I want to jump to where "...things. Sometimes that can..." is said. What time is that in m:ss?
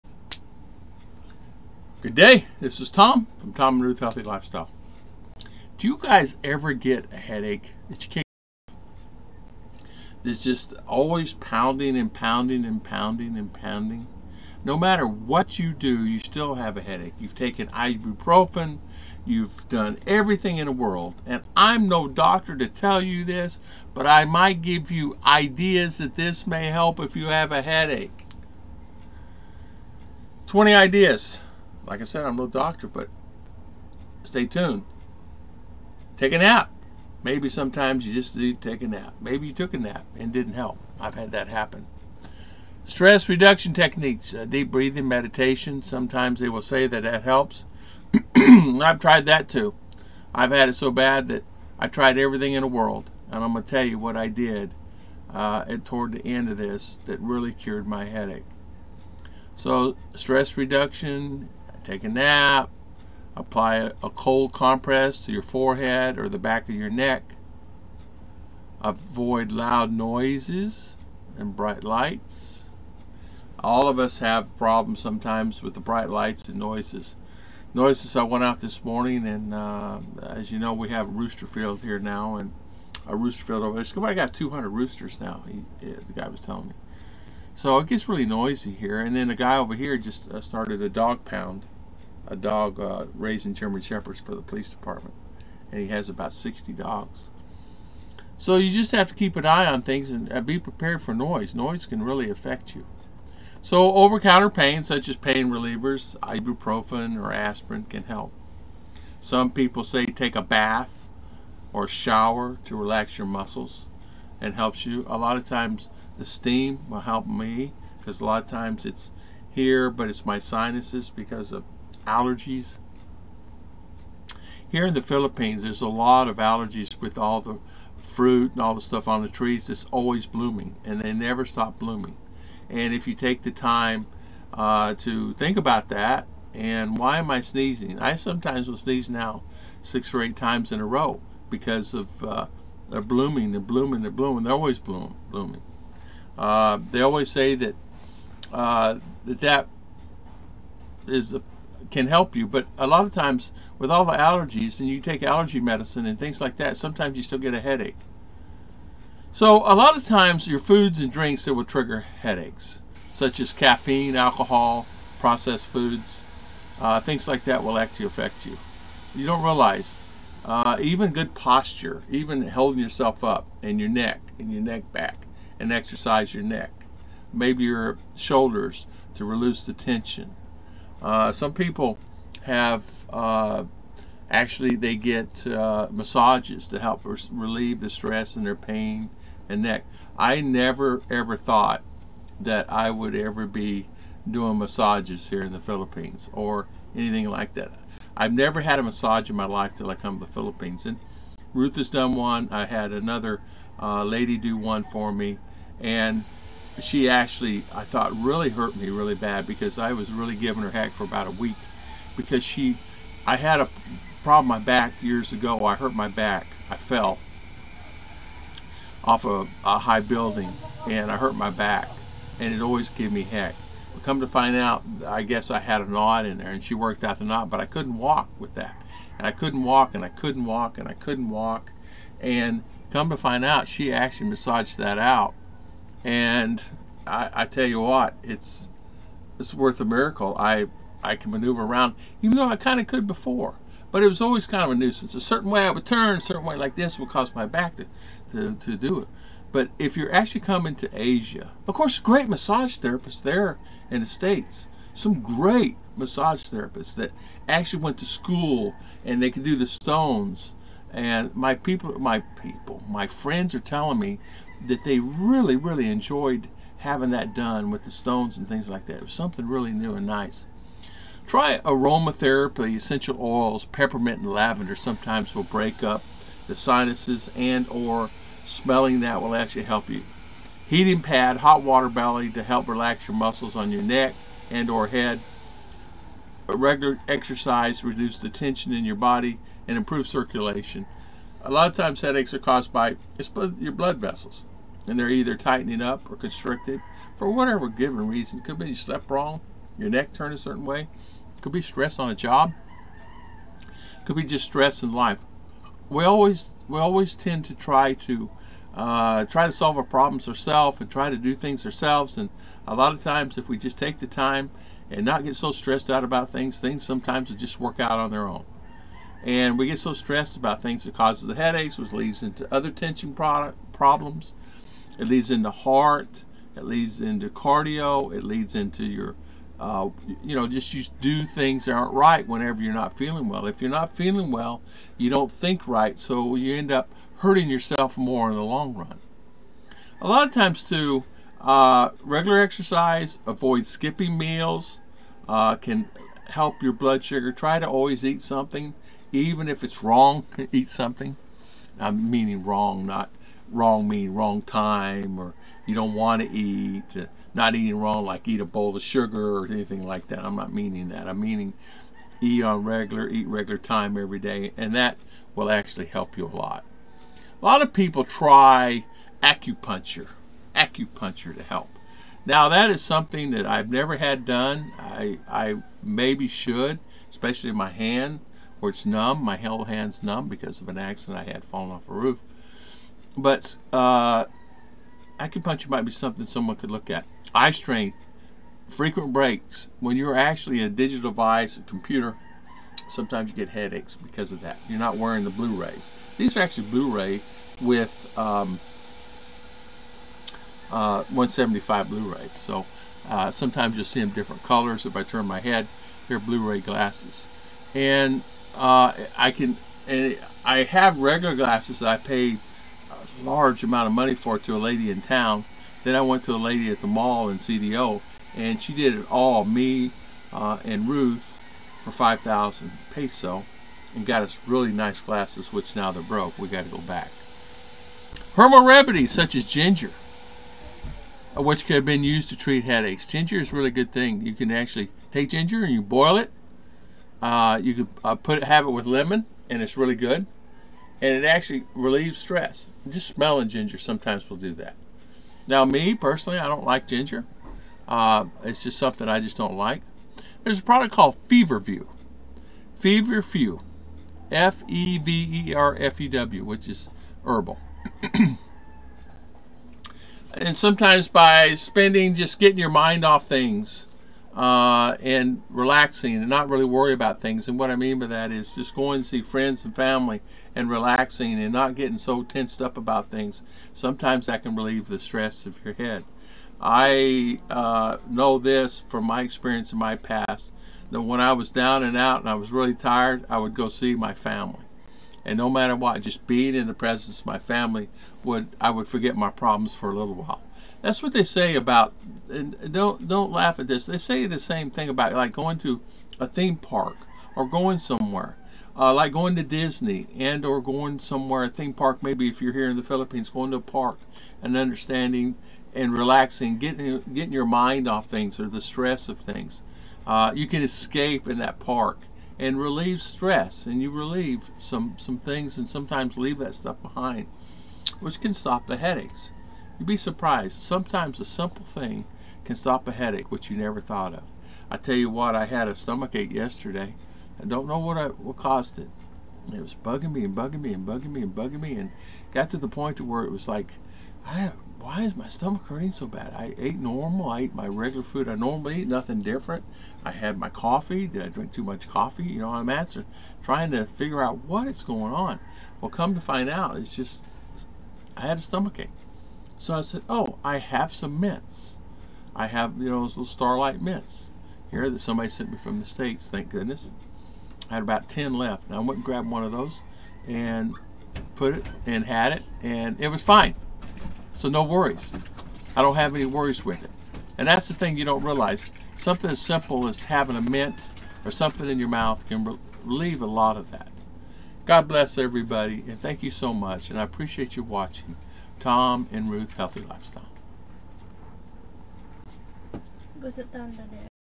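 7:53.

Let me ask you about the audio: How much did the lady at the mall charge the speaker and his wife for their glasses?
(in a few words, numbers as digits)
5,000 pesos.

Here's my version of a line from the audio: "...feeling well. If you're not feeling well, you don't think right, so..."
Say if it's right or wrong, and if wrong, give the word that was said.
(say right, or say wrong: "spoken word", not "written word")
right.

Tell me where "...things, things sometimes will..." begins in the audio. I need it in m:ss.
5:16.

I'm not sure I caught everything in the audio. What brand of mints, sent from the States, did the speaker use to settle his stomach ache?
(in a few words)
Starlight.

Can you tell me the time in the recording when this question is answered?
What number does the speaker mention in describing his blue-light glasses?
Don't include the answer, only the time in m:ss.
6:41.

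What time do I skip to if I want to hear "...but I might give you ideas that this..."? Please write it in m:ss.
0:23.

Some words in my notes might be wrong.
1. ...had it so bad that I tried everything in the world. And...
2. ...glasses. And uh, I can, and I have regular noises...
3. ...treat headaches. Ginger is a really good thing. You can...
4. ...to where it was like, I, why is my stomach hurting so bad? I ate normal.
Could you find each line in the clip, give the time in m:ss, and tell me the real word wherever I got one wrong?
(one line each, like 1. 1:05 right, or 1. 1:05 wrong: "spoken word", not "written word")
1. 0:50 right
2. 6:46 wrong: "glasses", not "noises"
3. 7:12 right
4. 8:52 right.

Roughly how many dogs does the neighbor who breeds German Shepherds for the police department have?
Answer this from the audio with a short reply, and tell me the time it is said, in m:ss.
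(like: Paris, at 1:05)
60, at 1:36.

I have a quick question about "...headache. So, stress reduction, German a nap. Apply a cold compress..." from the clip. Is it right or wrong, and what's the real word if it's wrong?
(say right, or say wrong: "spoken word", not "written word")
wrong: "Take", not "German".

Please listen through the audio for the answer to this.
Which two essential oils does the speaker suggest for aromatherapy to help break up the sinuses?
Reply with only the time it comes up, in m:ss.
4:33.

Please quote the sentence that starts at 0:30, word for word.
20 ideas like I said, I'm no doctor, but stay tuned.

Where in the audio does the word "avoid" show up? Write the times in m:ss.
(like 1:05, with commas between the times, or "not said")
1:08, 5:43.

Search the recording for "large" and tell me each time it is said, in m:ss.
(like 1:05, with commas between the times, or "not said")
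6:53.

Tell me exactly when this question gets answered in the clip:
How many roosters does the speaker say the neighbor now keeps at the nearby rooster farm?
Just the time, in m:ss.
1:24.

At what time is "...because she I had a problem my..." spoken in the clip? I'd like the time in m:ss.
3:32.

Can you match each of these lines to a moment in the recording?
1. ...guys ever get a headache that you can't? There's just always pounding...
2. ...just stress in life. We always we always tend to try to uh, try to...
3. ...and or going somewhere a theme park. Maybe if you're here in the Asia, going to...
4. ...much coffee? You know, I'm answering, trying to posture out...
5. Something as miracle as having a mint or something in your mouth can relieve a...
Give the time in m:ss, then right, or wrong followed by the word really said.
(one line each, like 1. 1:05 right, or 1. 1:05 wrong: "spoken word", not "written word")
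1. 0:05 right
2. 5:04 right
3. 8:20 wrong: "Philippines", not "Asia"
4. 9:01 wrong: "figure", not "posture"
5. 9:28 wrong: "simple", not "miracle".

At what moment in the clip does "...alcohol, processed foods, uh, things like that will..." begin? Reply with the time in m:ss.
2:44.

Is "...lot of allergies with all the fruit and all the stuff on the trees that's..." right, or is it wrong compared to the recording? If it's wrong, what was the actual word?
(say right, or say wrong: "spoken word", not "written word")
right.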